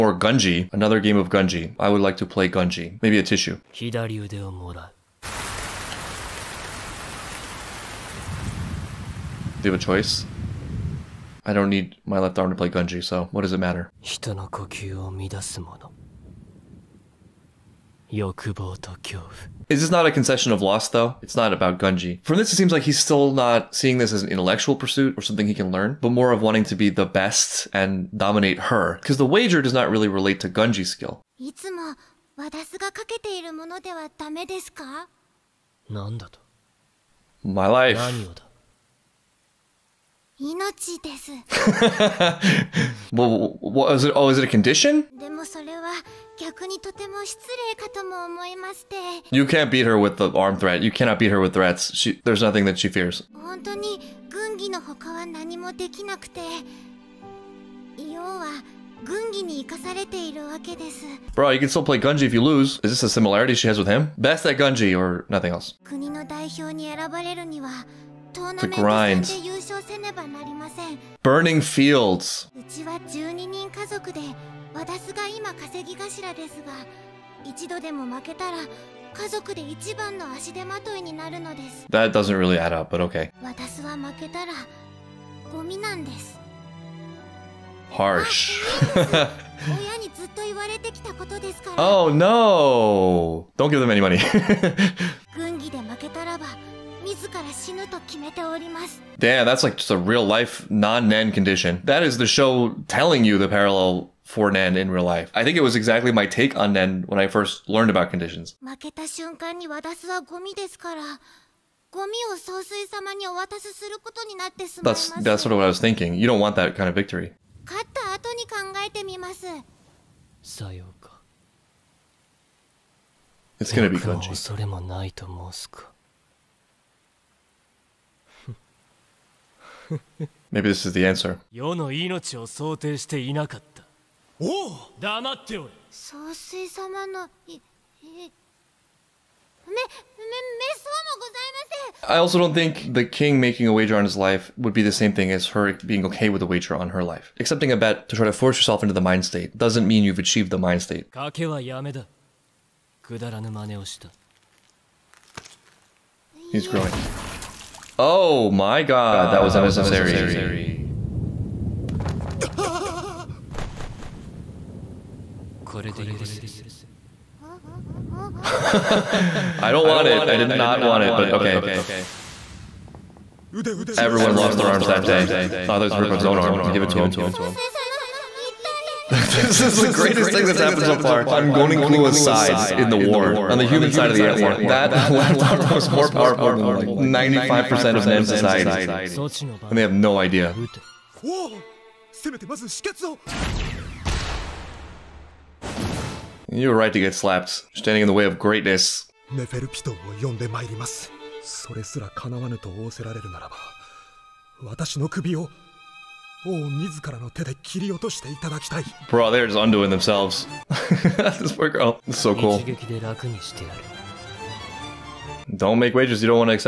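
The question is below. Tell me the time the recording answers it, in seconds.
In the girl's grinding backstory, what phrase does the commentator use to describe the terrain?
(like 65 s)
71 s.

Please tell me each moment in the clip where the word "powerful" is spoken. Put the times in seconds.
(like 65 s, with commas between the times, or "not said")
186 s.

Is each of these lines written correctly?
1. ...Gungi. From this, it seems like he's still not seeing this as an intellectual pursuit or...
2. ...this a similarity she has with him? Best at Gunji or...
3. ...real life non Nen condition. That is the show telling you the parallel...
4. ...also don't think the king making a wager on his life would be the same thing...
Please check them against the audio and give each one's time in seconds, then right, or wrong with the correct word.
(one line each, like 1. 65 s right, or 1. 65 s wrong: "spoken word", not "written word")
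1. 21 s right
2. 62 s right
3. 99 s right
4. 142 s right.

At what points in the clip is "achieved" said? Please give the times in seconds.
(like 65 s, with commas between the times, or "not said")
150 s.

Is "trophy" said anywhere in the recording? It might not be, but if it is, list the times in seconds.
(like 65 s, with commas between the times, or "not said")
not said.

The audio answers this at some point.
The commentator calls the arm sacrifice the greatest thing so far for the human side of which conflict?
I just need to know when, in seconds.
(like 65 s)
184 s.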